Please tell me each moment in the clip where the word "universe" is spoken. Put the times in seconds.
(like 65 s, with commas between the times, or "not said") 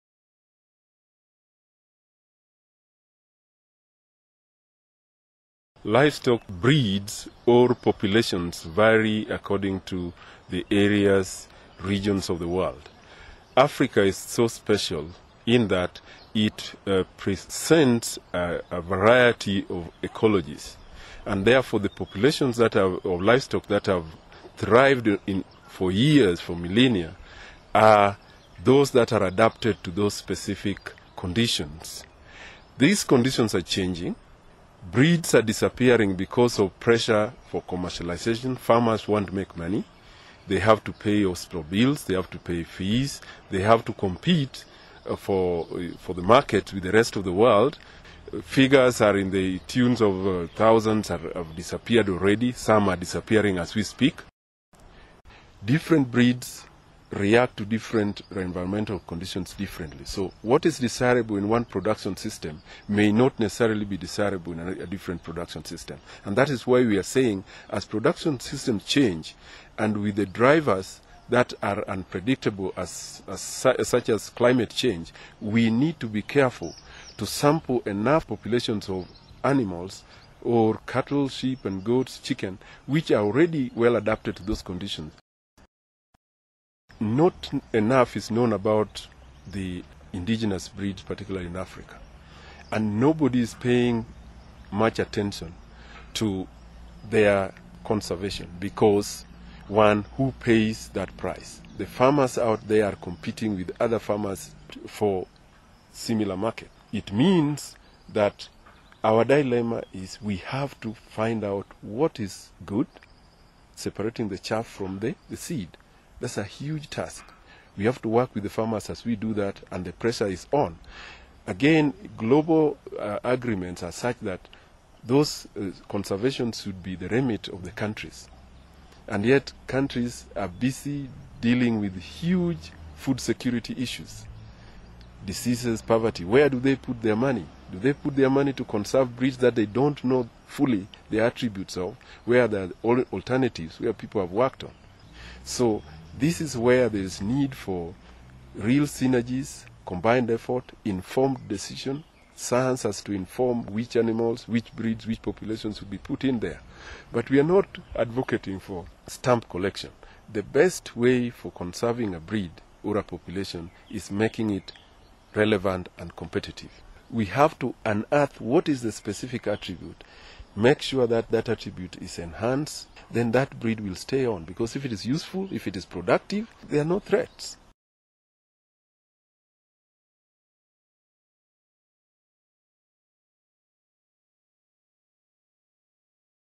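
not said.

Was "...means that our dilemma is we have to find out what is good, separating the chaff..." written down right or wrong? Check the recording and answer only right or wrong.
right.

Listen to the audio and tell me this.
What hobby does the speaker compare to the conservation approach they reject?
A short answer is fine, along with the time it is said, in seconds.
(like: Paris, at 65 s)
stamp collection, at 159 s.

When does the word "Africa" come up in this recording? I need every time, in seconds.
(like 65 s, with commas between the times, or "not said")
13 s, 91 s.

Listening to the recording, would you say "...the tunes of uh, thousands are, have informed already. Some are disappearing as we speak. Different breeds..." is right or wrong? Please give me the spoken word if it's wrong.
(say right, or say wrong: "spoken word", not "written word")
wrong: "disappeared", not "informed".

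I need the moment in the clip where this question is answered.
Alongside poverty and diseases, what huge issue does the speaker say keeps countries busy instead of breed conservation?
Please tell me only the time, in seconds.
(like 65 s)
132 s.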